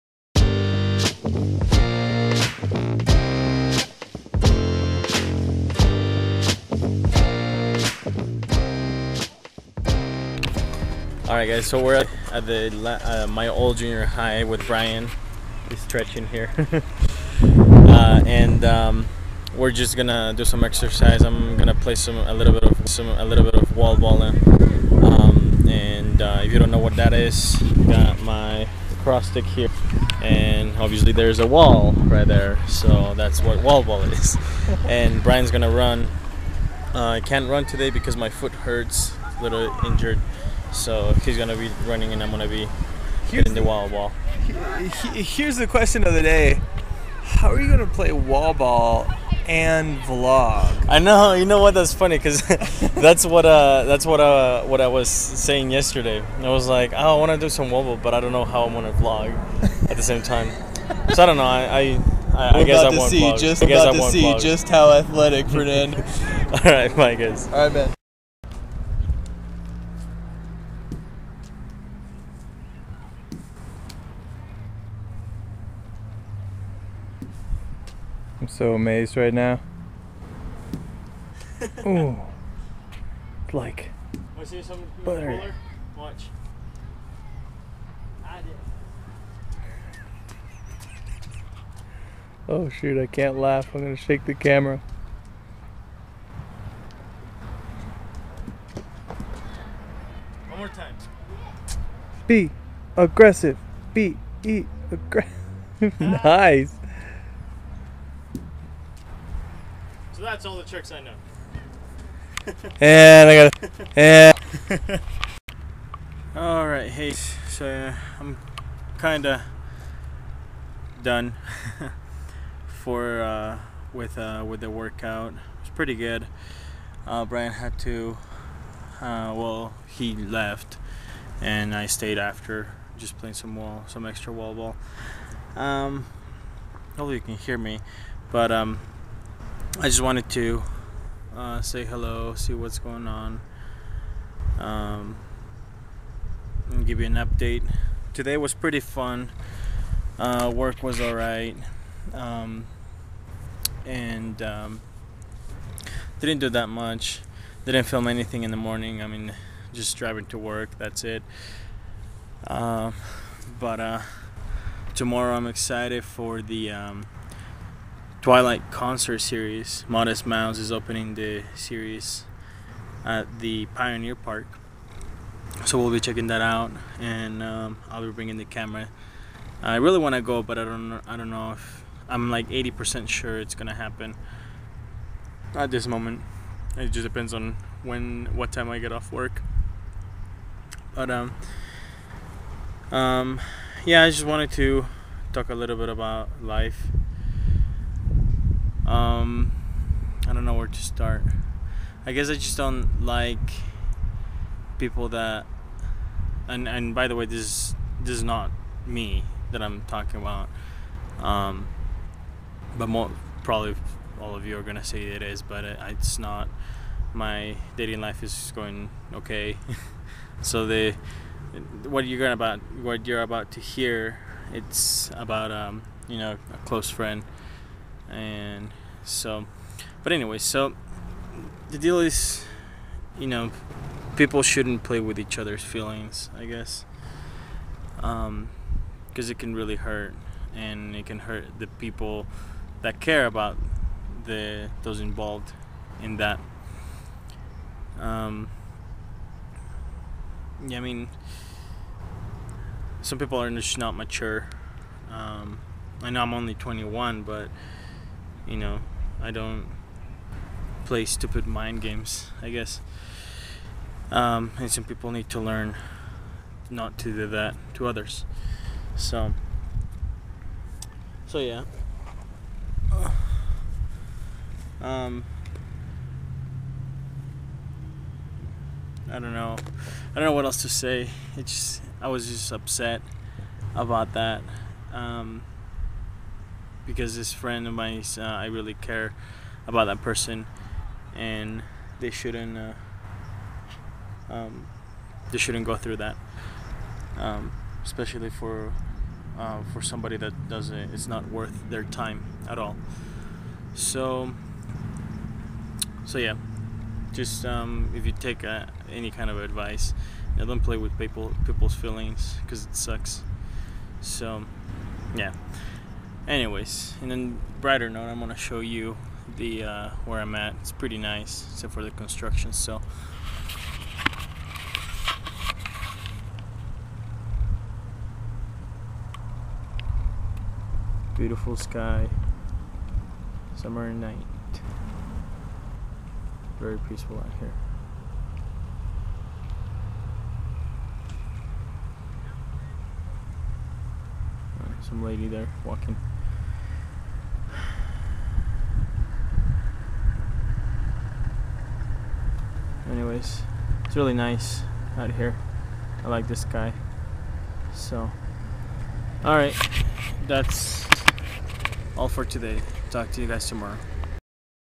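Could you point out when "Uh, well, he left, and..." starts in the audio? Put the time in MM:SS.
02:08.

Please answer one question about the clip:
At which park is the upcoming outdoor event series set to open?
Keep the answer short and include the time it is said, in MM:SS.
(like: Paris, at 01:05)
Pioneer Park, at 02:53.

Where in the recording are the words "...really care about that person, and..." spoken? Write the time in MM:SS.
04:48.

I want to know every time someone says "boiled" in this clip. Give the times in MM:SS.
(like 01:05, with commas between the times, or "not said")
not said.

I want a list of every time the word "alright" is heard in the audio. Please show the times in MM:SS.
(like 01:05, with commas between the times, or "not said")
02:31, 05:59.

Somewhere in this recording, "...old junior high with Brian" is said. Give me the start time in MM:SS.
00:13.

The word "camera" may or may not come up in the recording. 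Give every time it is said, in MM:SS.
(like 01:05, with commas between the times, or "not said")
01:34, 02:58.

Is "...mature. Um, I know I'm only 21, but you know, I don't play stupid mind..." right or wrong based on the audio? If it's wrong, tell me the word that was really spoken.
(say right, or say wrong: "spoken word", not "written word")
right.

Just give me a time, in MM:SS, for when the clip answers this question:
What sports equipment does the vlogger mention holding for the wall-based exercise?
00:29.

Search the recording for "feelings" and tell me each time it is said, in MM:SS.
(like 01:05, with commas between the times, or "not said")
03:55, 05:11.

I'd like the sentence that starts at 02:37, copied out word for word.
Didn't film anything in the morning.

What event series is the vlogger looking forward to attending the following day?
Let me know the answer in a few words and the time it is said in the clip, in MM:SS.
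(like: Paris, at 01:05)
Twilight concert series, at 02:48.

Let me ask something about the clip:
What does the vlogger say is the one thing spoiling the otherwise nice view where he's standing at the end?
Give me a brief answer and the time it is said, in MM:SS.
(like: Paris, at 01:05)
Construction, at 05:21.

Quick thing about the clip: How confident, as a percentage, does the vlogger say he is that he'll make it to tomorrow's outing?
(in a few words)
80%.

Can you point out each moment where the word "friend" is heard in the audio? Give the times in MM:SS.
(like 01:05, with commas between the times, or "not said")
03:46, 04:47.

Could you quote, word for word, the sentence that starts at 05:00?
It's not worth their time at all.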